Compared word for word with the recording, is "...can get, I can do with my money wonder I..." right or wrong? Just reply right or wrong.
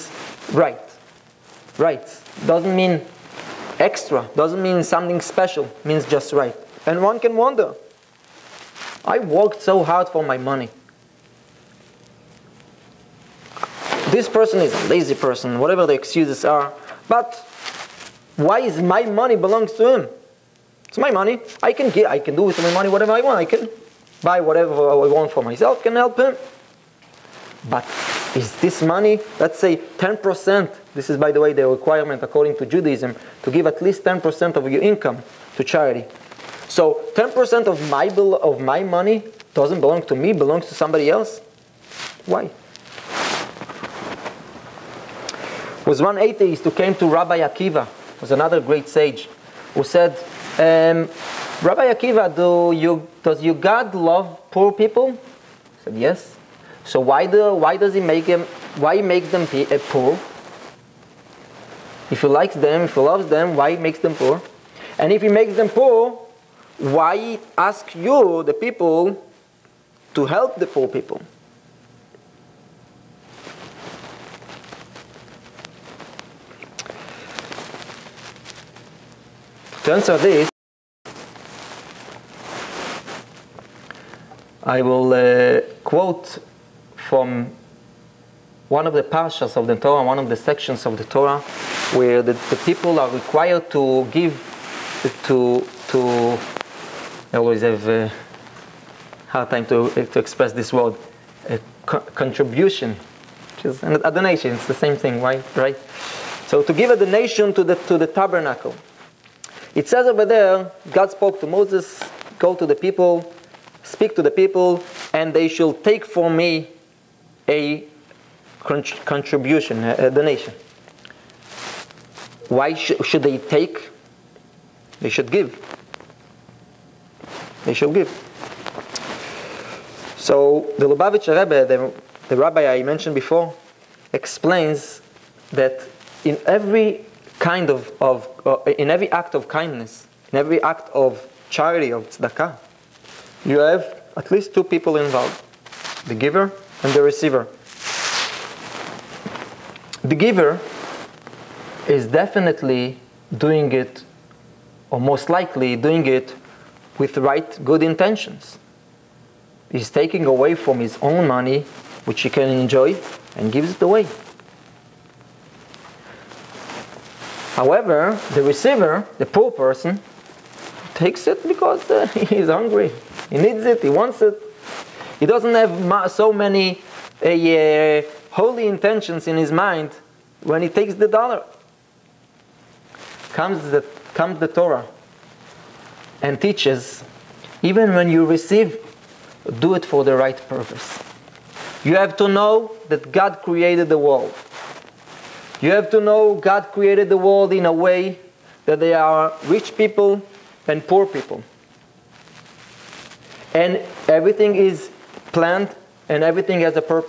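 wrong.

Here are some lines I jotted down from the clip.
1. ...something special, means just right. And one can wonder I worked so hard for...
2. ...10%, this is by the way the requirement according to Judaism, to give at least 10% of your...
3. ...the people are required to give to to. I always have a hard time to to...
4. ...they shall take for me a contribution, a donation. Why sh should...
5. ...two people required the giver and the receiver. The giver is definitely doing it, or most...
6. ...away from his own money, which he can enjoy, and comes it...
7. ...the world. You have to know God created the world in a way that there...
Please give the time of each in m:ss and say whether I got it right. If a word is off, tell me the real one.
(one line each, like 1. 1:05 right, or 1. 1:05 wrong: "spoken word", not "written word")
1. 0:04 right
2. 0:29 right
3. 1:32 right
4. 1:55 right
5. 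2:24 wrong: "involved", not "required"
6. 2:40 wrong: "gives", not "comes"
7. 3:13 right.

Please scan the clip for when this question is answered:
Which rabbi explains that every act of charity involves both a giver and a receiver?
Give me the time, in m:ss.
2:10.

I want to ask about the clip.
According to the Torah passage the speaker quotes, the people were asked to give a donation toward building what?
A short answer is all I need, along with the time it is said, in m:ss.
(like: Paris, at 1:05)
the tabernacle, at 1:48.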